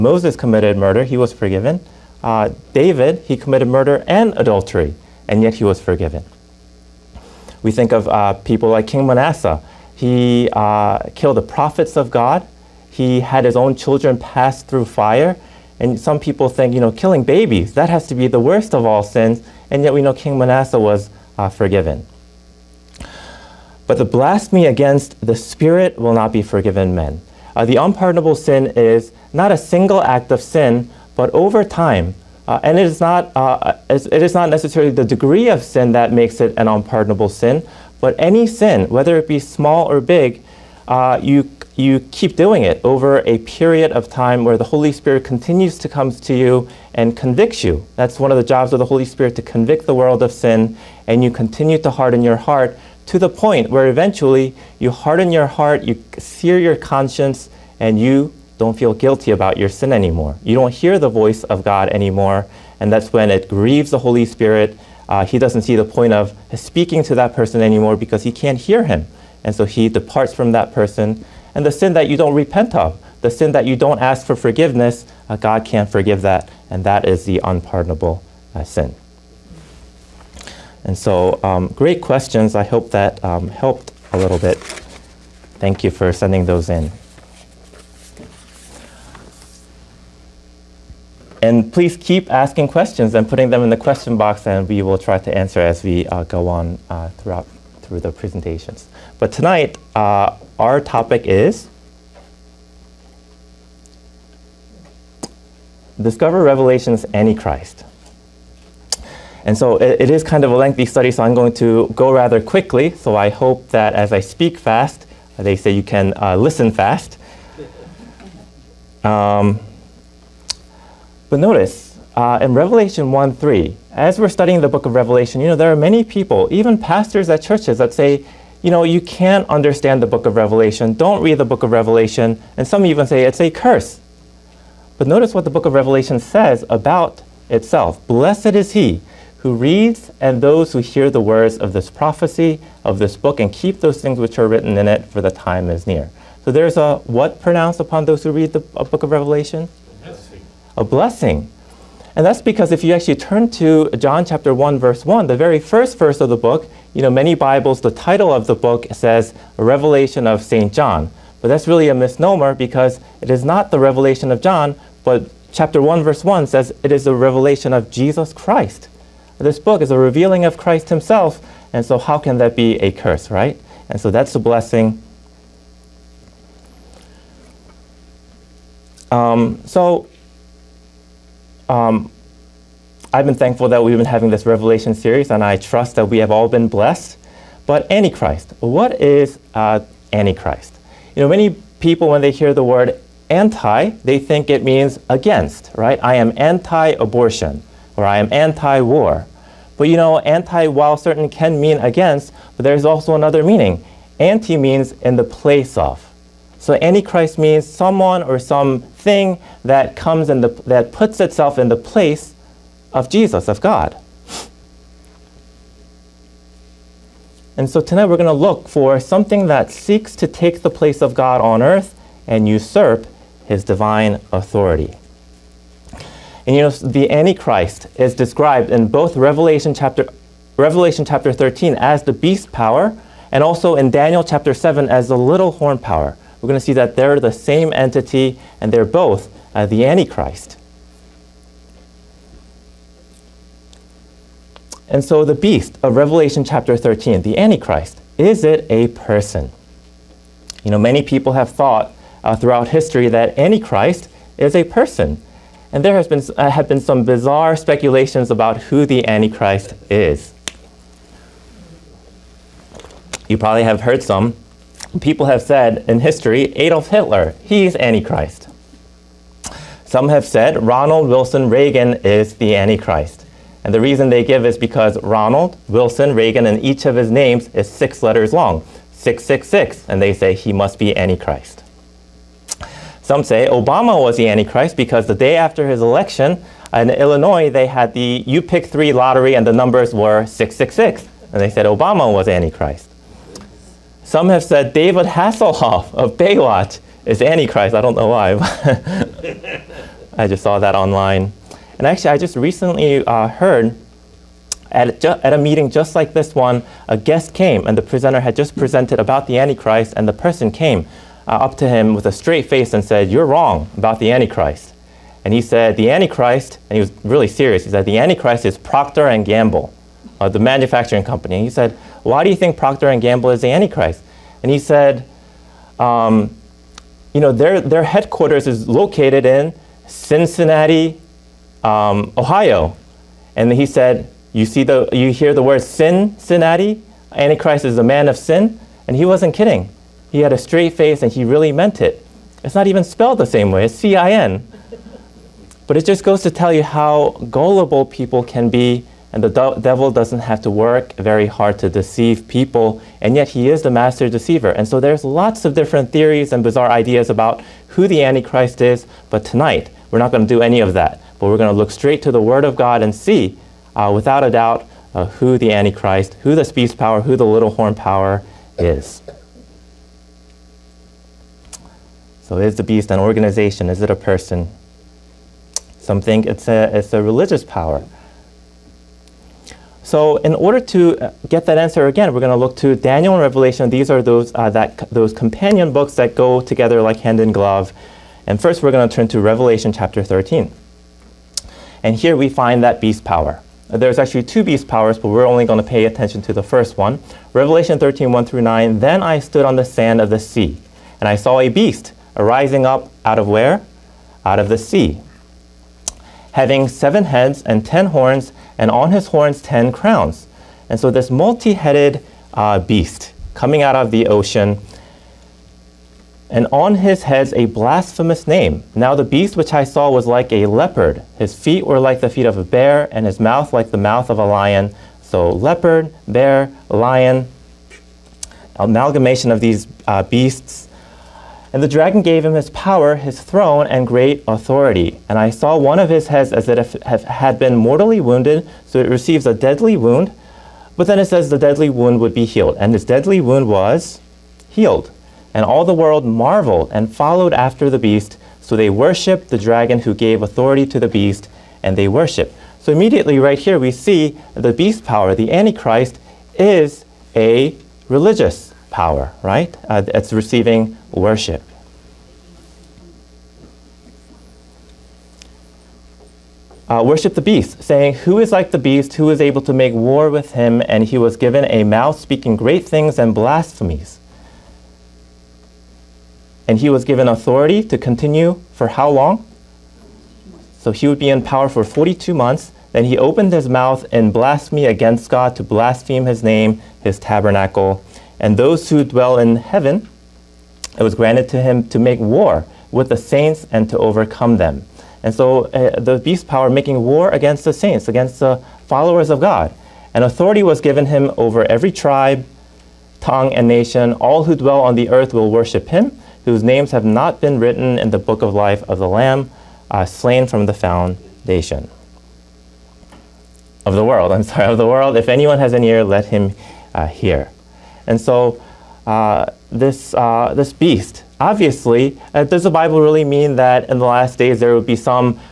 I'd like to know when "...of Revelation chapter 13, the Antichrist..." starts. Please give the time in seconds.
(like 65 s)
245 s.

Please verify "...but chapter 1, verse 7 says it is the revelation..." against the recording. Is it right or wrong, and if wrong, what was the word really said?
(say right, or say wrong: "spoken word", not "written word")
wrong: "1", not "7".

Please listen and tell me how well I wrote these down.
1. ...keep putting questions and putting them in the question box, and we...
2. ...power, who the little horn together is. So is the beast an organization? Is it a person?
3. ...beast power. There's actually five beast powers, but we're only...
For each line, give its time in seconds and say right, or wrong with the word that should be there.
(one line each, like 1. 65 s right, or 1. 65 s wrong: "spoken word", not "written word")
1. 91 s wrong: "asking", not "putting"
2. 366 s wrong: "power", not "together"
3. 392 s wrong: "two", not "five".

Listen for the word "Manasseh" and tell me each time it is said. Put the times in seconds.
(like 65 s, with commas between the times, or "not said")
9 s, 20 s.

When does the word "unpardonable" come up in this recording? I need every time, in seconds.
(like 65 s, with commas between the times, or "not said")
27 s, 36 s, 77 s.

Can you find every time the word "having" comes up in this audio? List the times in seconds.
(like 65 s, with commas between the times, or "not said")
184 s, 406 s.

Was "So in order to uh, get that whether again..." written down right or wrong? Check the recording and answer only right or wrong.
wrong.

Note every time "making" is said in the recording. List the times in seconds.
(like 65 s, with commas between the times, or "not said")
496 s.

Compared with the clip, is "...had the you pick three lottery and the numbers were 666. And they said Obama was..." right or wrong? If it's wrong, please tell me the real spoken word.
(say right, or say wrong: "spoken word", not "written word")
right.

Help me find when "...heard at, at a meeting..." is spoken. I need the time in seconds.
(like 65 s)
303 s.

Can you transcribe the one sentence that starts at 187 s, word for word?
But Antichrist, what is uh, Antichrist?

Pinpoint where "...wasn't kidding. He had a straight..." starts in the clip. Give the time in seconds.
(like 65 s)
339 s.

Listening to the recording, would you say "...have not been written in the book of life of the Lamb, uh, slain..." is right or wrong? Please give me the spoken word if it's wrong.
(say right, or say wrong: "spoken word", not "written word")
right.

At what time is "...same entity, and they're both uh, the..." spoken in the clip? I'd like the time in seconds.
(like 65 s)
237 s.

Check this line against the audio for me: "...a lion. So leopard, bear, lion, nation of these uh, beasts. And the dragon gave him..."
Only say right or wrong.
wrong.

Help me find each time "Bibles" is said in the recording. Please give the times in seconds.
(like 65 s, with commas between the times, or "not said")
157 s, 522 s.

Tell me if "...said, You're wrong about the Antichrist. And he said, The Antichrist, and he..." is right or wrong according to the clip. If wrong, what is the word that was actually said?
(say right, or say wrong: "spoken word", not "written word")
right.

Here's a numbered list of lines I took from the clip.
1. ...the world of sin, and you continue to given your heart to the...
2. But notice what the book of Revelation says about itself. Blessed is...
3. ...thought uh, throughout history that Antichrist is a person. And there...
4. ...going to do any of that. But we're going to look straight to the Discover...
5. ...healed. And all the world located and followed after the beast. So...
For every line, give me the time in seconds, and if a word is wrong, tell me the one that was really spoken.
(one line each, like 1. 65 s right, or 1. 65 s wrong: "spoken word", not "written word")
1. 49 s wrong: "harden", not "given"
2. 134 s right
3. 251 s right
4. 360 s wrong: "Word", not "Discover"
5. 444 s wrong: "marveled", not "located".